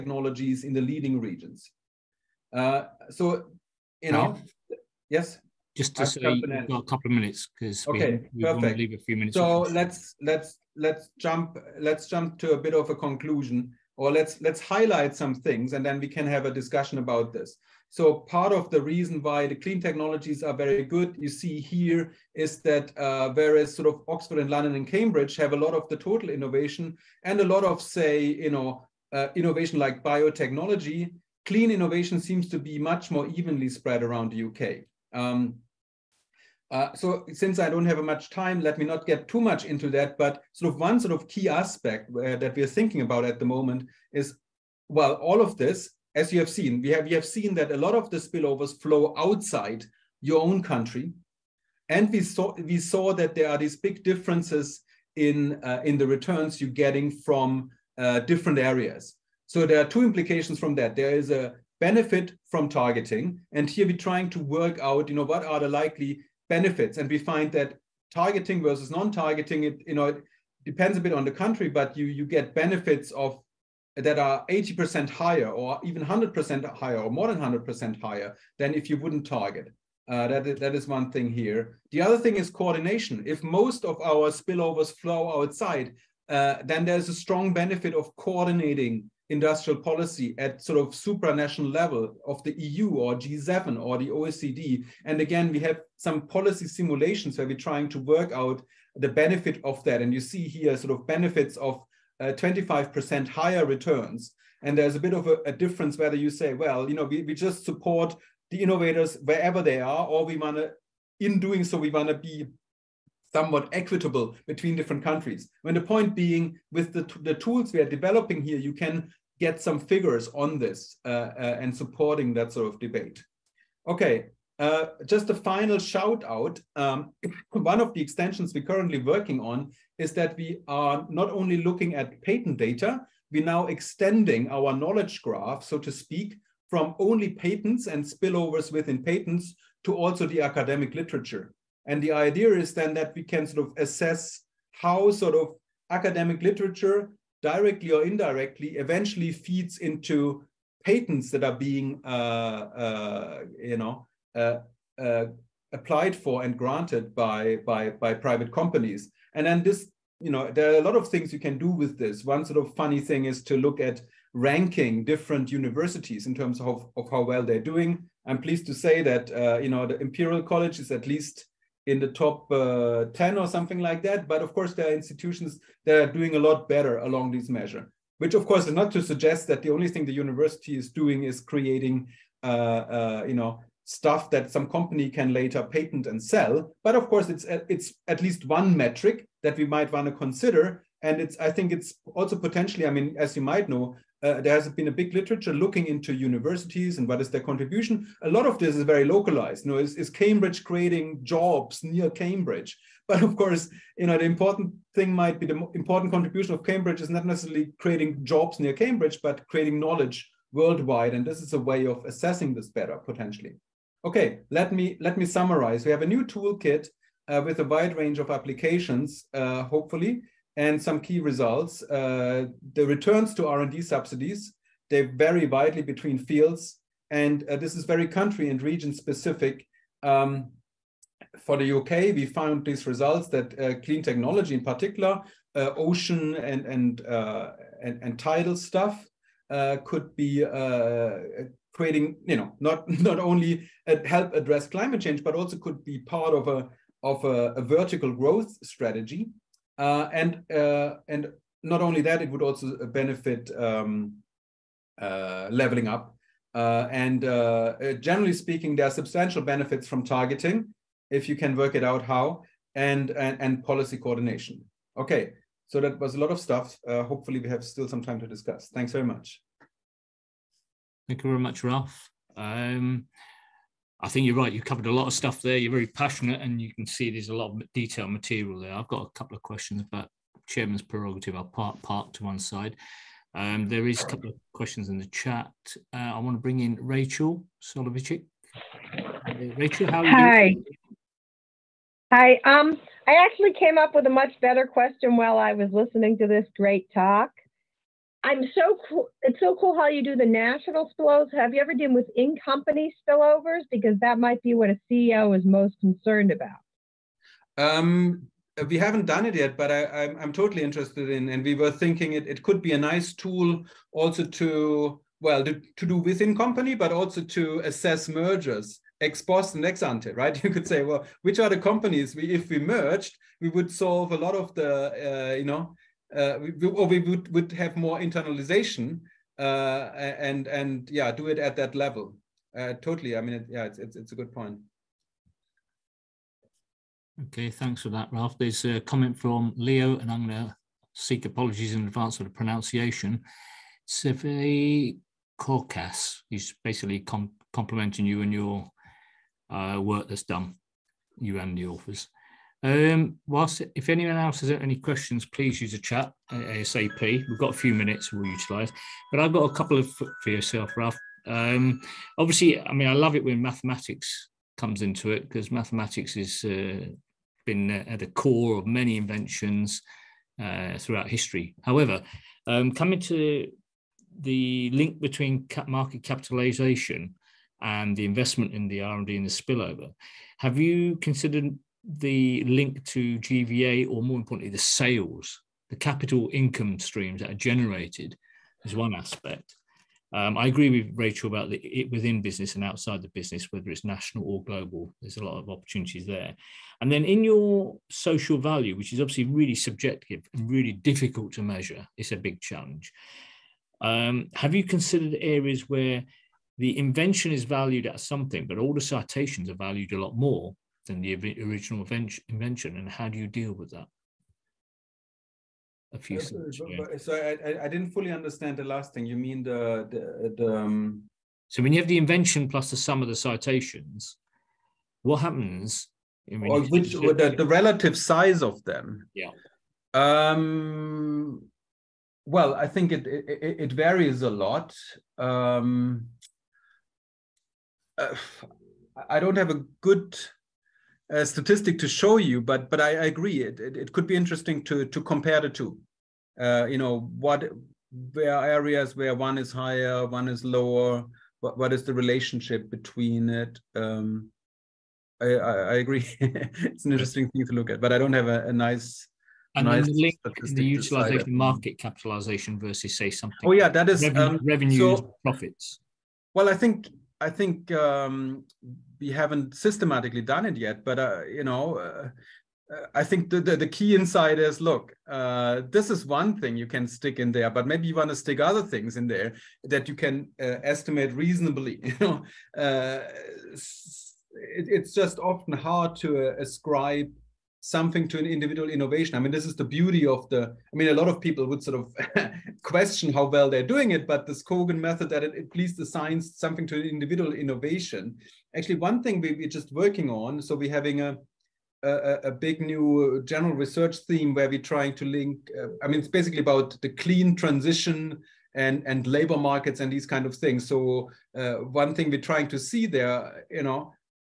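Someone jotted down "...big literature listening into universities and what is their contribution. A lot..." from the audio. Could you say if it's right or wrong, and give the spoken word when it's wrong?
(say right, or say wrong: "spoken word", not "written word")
wrong: "looking", not "listening".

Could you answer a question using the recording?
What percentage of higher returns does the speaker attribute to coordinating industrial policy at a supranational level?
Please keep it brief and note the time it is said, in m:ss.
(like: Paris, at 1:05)
25%, at 1:42.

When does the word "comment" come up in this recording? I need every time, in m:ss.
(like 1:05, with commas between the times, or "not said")
5:38.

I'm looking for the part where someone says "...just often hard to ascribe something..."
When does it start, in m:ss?
8:04.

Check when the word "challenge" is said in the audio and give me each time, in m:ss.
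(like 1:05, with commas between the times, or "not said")
6:42.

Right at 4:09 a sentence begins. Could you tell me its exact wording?
Uh, and uh, and not only that, it would also benefit um, uh, leveling up.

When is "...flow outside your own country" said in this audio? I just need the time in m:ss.
0:48.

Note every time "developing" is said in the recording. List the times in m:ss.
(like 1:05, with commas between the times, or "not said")
1:57.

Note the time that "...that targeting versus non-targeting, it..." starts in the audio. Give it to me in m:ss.
1:07.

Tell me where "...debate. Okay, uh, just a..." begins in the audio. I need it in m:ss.
2:02.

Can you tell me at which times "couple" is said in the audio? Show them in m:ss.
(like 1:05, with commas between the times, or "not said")
0:06, 4:39, 4:44, 5:59.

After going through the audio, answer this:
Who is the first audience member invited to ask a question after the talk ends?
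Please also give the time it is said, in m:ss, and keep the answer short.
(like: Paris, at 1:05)
Rachel Soloveichik, at 4:46.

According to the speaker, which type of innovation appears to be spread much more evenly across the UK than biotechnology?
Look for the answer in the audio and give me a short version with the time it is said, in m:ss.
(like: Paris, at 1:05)
Clean innovation, at 0:31.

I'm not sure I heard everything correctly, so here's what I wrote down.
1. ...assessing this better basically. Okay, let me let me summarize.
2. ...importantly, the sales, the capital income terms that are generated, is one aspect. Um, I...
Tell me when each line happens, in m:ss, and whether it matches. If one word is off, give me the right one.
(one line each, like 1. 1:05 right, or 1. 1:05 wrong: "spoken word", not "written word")
1. 3:32 wrong: "potentially", not "basically"
2. 6:24 wrong: "streams", not "terms".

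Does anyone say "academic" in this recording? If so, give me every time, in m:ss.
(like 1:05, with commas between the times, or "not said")
2:20, 2:25.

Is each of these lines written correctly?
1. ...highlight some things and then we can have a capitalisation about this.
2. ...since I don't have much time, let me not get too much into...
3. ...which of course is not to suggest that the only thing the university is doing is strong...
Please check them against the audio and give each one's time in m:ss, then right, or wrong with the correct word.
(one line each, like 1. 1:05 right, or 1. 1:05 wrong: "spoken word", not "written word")
1. 0:14 wrong: "discussion", not "capitalisation"
2. 0:37 right
3. 2:58 wrong: "creating", not "strong".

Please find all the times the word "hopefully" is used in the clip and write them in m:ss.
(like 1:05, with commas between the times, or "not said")
3:39, 4:27.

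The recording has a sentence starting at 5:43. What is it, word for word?
Seve He's basically com complimenting you and your uh, work that's done, you and the authors.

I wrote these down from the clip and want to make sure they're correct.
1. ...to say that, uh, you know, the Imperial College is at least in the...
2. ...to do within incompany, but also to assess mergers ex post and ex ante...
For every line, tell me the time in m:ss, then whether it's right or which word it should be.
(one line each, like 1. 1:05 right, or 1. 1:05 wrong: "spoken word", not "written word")
1. 2:48 right
2. 5:15 wrong: "company", not "incompany".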